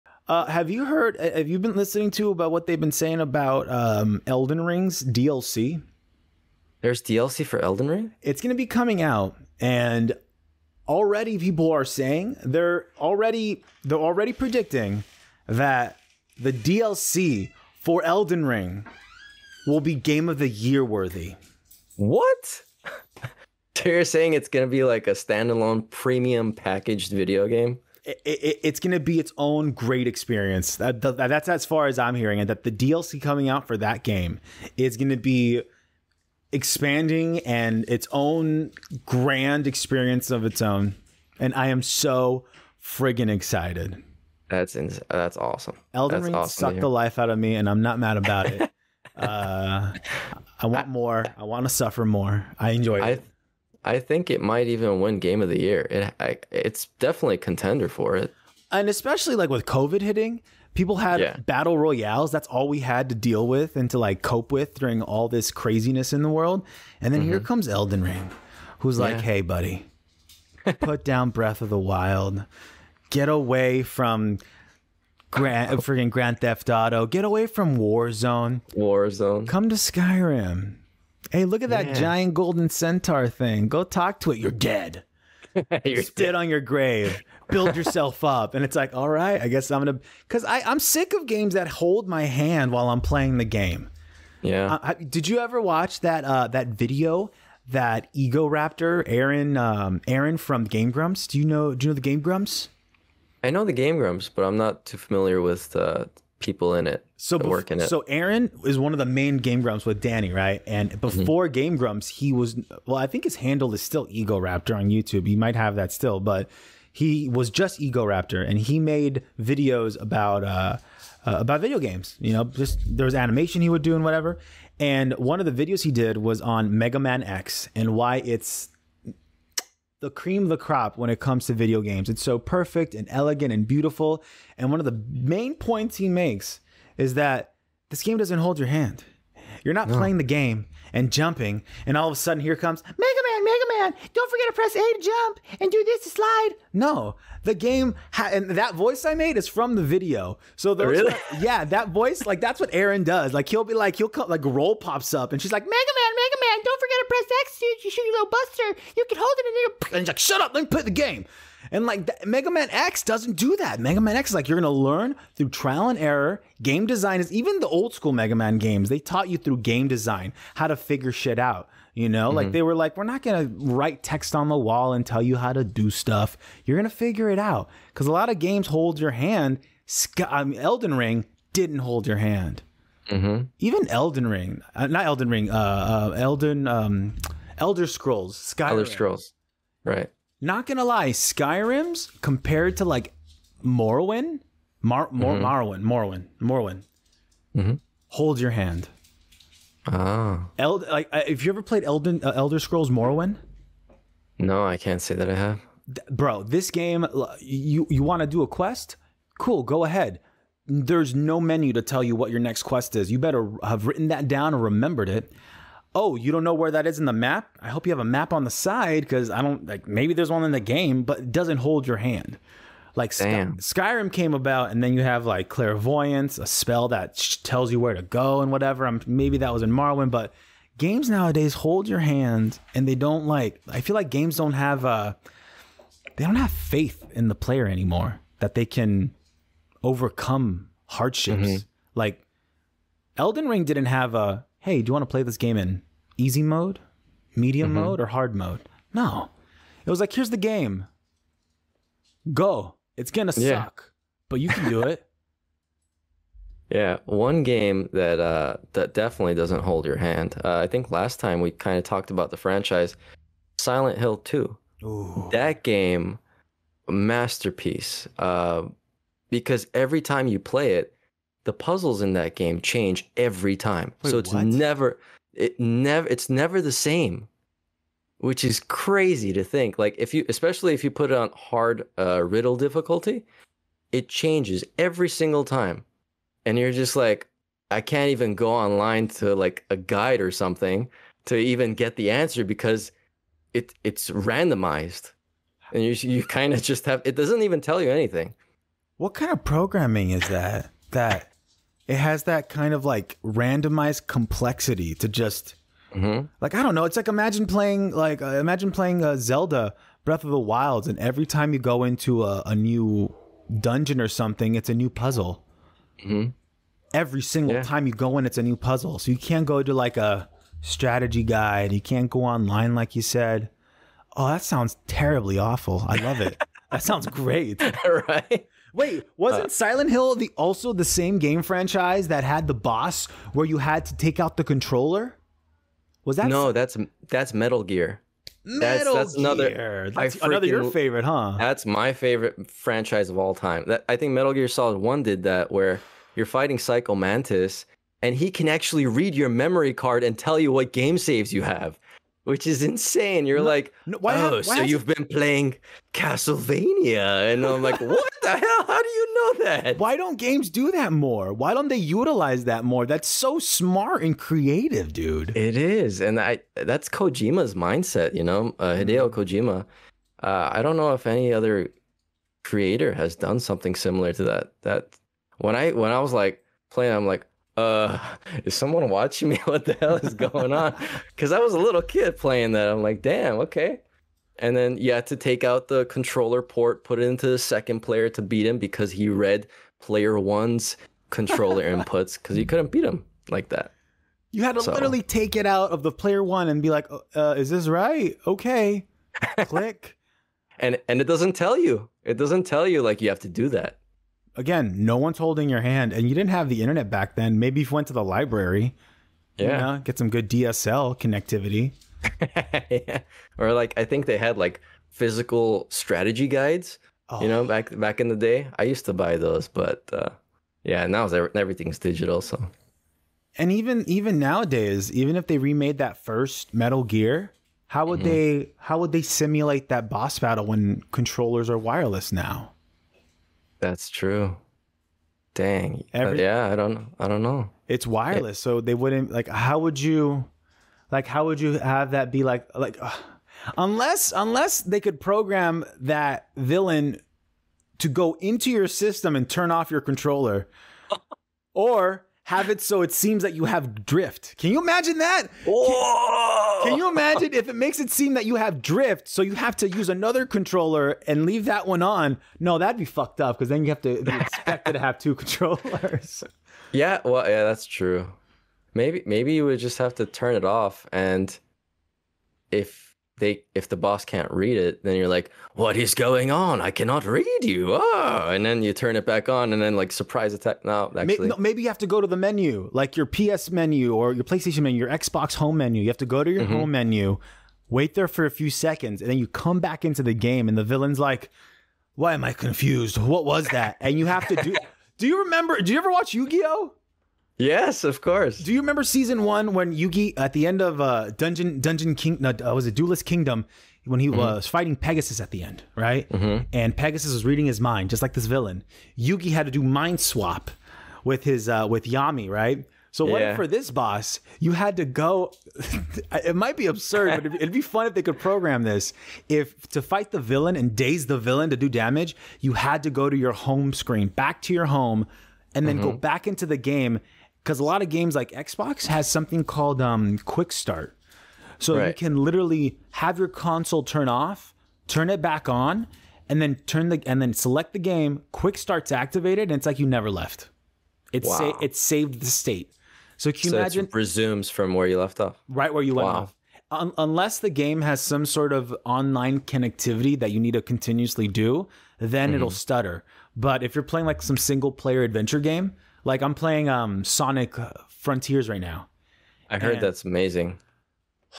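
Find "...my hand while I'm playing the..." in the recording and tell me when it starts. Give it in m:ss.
1:32.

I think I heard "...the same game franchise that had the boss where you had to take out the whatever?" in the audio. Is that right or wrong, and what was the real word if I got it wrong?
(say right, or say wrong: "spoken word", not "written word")
wrong: "controller", not "whatever".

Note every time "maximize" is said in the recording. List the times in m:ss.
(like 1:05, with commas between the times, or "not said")
not said.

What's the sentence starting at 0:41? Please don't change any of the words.
And I am so friggin' excited.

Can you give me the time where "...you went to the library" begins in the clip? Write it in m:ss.
6:47.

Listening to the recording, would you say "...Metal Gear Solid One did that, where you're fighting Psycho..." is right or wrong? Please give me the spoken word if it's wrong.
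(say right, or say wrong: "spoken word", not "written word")
right.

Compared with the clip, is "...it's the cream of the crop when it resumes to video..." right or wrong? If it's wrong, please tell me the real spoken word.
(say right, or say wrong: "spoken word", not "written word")
wrong: "comes", not "resumes".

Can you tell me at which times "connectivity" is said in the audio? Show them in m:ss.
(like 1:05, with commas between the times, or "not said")
6:50, 9:09.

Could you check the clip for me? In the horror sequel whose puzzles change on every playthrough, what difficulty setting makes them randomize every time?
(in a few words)
Riddle difficulty.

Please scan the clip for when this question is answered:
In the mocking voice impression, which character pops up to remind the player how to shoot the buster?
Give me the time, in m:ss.
2:34.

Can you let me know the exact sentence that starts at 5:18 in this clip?
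So you can't go to like a strategy guide.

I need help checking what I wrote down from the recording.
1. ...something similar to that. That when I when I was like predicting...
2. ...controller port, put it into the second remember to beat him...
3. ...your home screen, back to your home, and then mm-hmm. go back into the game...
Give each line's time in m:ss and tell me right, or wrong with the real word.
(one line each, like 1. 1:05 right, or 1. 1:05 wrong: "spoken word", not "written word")
1. 6:13 wrong: "playing", not "predicting"
2. 6:25 wrong: "player", not "remember"
3. 8:43 right.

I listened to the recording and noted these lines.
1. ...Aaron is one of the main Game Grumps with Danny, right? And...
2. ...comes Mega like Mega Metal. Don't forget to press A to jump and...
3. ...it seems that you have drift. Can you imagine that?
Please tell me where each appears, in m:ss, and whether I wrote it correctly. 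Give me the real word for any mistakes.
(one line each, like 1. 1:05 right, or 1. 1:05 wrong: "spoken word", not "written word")
1. 1:48 right
2. 2:22 wrong: "Man", not "Metal"
3. 7:32 right.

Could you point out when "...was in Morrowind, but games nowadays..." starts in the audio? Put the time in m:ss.
3:49.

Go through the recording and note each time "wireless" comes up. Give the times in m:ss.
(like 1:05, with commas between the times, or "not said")
7:11, 7:17.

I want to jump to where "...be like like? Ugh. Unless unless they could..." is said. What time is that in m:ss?
7:22.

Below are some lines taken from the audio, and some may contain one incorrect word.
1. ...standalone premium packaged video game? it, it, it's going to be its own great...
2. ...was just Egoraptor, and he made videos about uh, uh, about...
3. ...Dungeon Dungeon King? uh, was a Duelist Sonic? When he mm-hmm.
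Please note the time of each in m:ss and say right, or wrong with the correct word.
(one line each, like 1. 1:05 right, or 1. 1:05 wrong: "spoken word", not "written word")
1. 0:25 right
2. 1:57 right
3. 8:21 wrong: "Kingdom", not "Sonic".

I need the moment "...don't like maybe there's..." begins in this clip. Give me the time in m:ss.
3:39.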